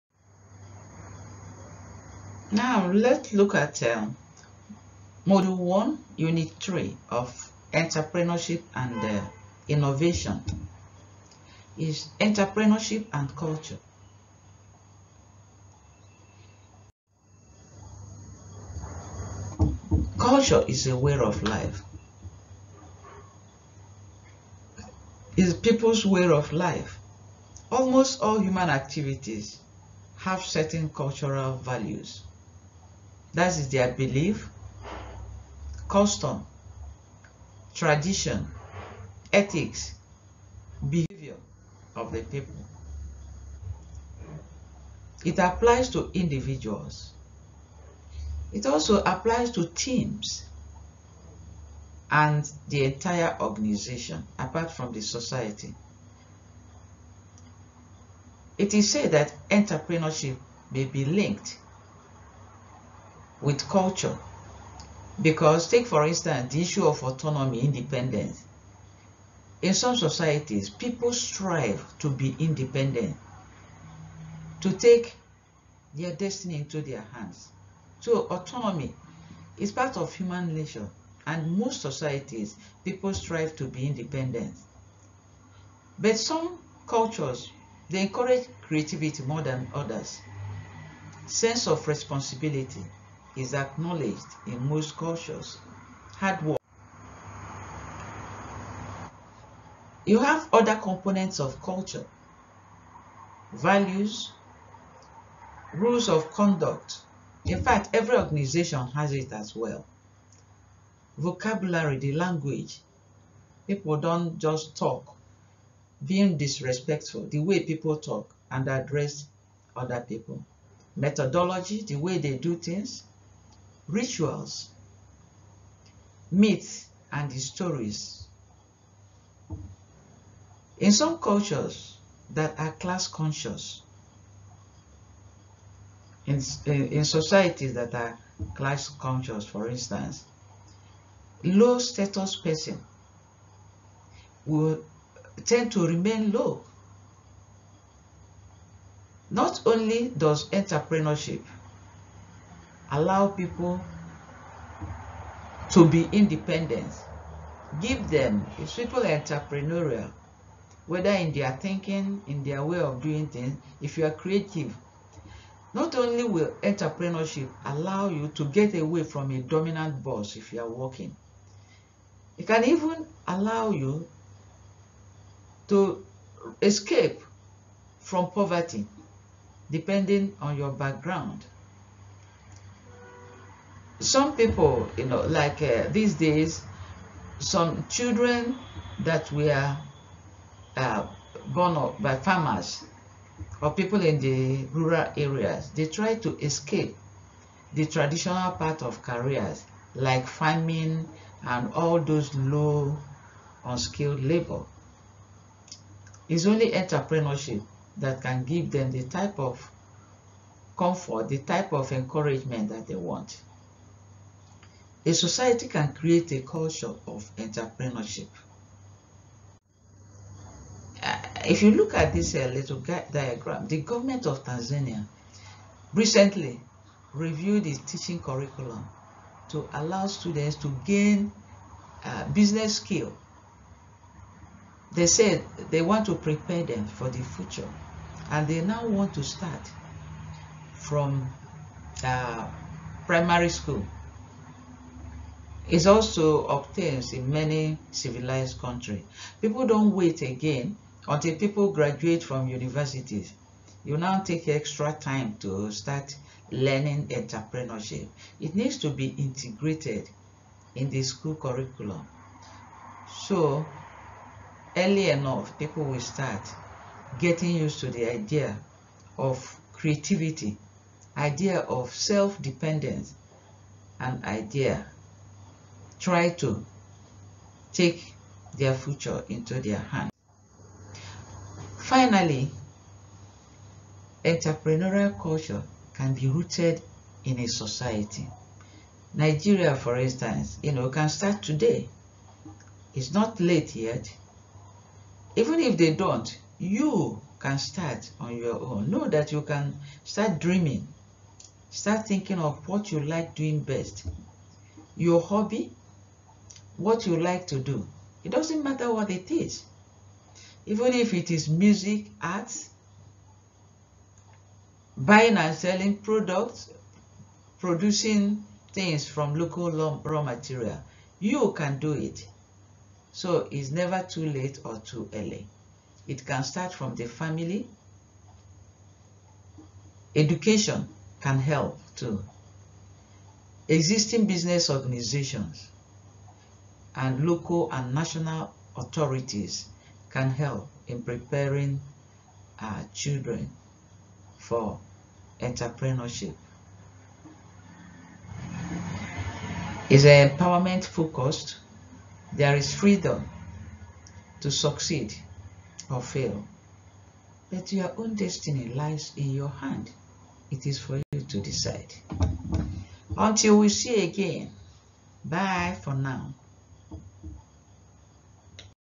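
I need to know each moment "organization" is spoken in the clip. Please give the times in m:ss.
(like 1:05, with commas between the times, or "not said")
0:53, 1:48, 5:34.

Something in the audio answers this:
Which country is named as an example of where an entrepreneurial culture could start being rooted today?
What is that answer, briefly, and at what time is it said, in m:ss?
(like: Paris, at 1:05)
Nigeria, at 4:49.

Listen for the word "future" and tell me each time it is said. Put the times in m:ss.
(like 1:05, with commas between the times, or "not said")
3:57, 4:38.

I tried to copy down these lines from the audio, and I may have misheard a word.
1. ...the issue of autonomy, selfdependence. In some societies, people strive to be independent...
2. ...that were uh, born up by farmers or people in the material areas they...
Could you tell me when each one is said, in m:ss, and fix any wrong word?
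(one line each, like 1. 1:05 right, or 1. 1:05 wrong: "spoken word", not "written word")
1. 1:06 wrong: "independence", not "selfdependence"
2. 3:09 wrong: "rural", not "material".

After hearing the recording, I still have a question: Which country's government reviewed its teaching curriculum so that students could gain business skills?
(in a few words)
Tanzania.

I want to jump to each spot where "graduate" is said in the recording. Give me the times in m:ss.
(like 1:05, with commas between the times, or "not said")
4:11.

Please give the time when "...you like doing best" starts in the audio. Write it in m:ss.
5:02.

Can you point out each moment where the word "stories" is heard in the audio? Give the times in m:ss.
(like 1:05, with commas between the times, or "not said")
2:07.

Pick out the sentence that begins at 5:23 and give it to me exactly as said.
So it's never too late or too early.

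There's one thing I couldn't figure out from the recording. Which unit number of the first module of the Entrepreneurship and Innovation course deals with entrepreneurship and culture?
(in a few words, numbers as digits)
Unit 3.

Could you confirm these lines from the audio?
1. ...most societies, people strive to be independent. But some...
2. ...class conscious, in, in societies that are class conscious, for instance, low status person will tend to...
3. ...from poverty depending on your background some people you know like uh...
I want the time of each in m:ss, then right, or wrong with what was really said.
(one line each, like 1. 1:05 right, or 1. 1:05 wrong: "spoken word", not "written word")
1. 1:21 right
2. 2:12 right
3. 2:58 right.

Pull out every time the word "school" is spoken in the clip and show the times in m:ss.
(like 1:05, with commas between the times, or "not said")
4:03, 4:21.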